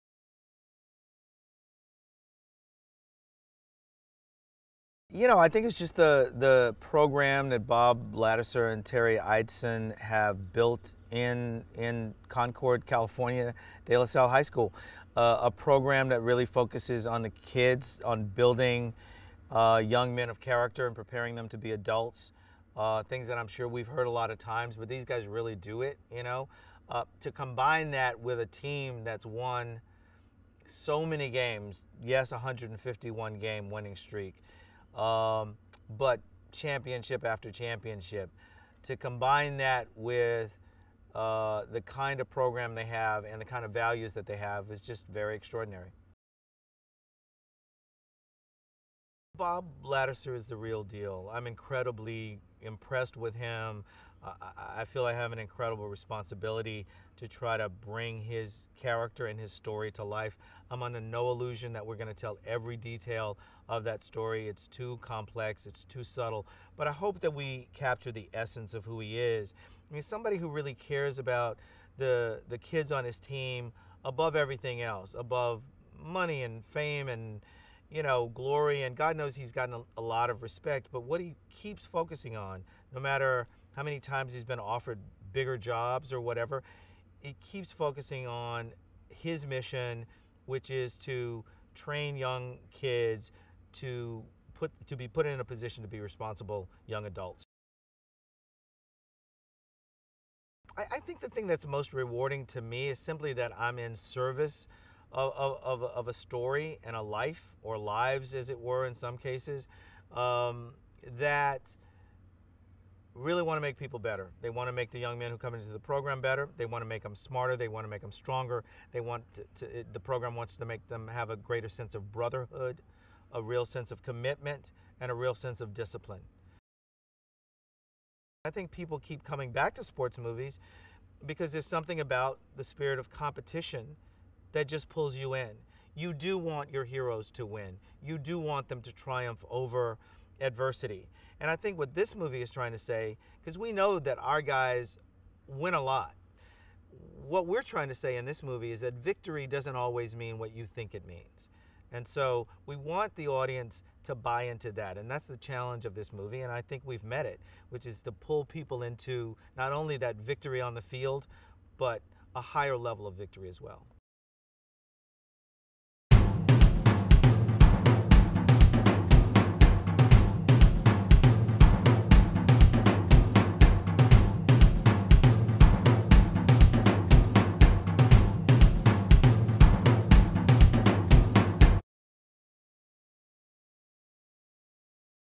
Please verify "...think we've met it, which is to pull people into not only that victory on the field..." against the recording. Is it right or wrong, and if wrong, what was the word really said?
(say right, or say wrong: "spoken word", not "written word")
right.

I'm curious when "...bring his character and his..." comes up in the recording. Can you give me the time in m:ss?
0:57.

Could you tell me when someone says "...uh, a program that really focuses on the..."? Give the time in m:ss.
0:15.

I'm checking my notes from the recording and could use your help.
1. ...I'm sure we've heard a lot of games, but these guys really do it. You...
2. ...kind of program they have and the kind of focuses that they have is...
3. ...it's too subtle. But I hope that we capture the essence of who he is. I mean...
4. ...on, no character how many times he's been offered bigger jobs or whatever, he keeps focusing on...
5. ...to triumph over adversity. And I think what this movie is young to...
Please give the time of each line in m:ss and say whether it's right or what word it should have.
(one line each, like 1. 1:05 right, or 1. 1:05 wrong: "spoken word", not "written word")
1. 0:23 wrong: "times", not "games"
2. 0:41 wrong: "values", not "focuses"
3. 1:05 right
4. 1:22 wrong: "matter", not "character"
5. 2:18 wrong: "trying", not "young".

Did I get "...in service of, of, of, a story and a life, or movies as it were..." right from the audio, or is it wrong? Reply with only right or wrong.
wrong.